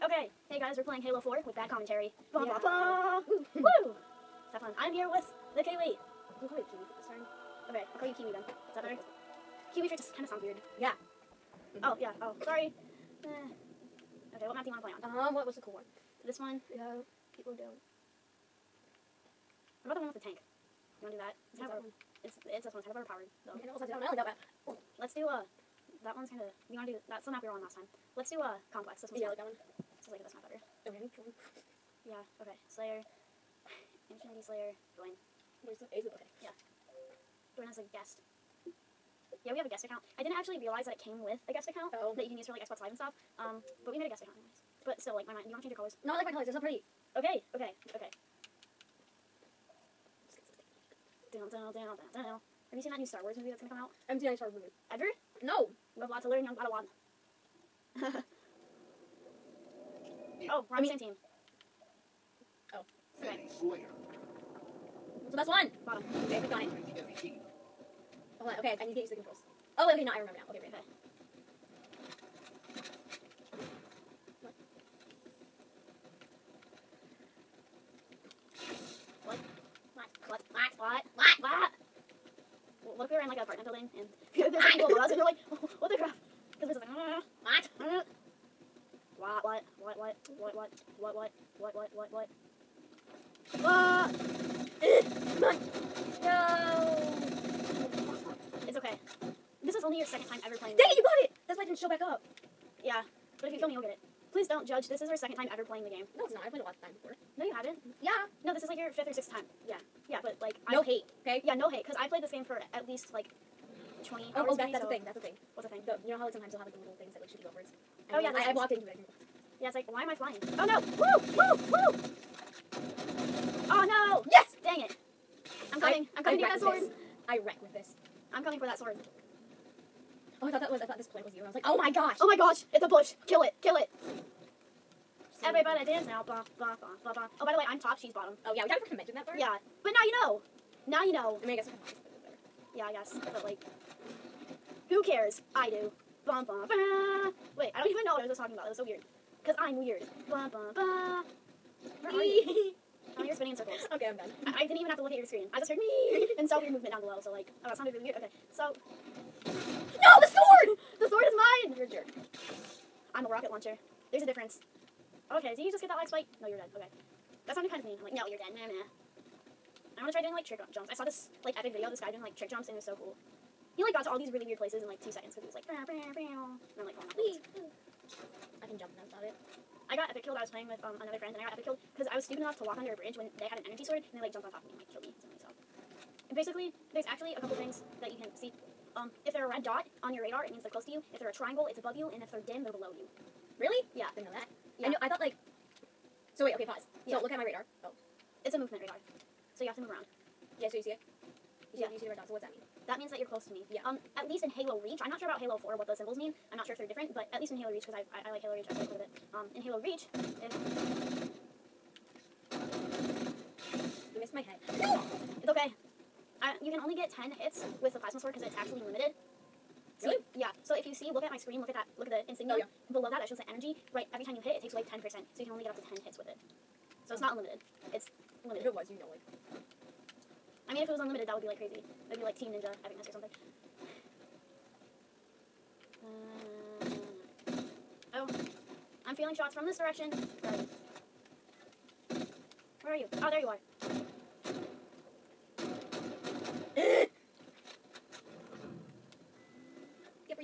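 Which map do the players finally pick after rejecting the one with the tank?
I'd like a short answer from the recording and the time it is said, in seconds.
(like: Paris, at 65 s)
Complex, at 28 s.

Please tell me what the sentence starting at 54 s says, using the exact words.
I haven't seen any Star Wars movie.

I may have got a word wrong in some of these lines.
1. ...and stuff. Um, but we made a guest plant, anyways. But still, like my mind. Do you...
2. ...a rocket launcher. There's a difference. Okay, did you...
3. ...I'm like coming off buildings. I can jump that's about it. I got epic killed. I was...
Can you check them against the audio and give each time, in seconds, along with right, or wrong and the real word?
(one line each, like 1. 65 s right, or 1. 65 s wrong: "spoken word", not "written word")
1. 42 s wrong: "account", not "plant"
2. 163 s right
3. 176 s wrong: "falling", not "coming".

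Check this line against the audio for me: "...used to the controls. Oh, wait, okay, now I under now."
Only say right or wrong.
wrong.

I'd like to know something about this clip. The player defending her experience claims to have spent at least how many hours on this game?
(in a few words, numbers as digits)
20.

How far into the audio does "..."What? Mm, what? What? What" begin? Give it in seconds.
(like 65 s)
87 s.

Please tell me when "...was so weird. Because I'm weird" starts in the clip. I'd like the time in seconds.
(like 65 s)
148 s.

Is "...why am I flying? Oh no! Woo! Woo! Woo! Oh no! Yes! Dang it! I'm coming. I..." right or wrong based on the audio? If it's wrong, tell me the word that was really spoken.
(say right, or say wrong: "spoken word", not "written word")
right.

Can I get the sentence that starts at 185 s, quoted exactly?
So basically, there's actually a couple things that you can see.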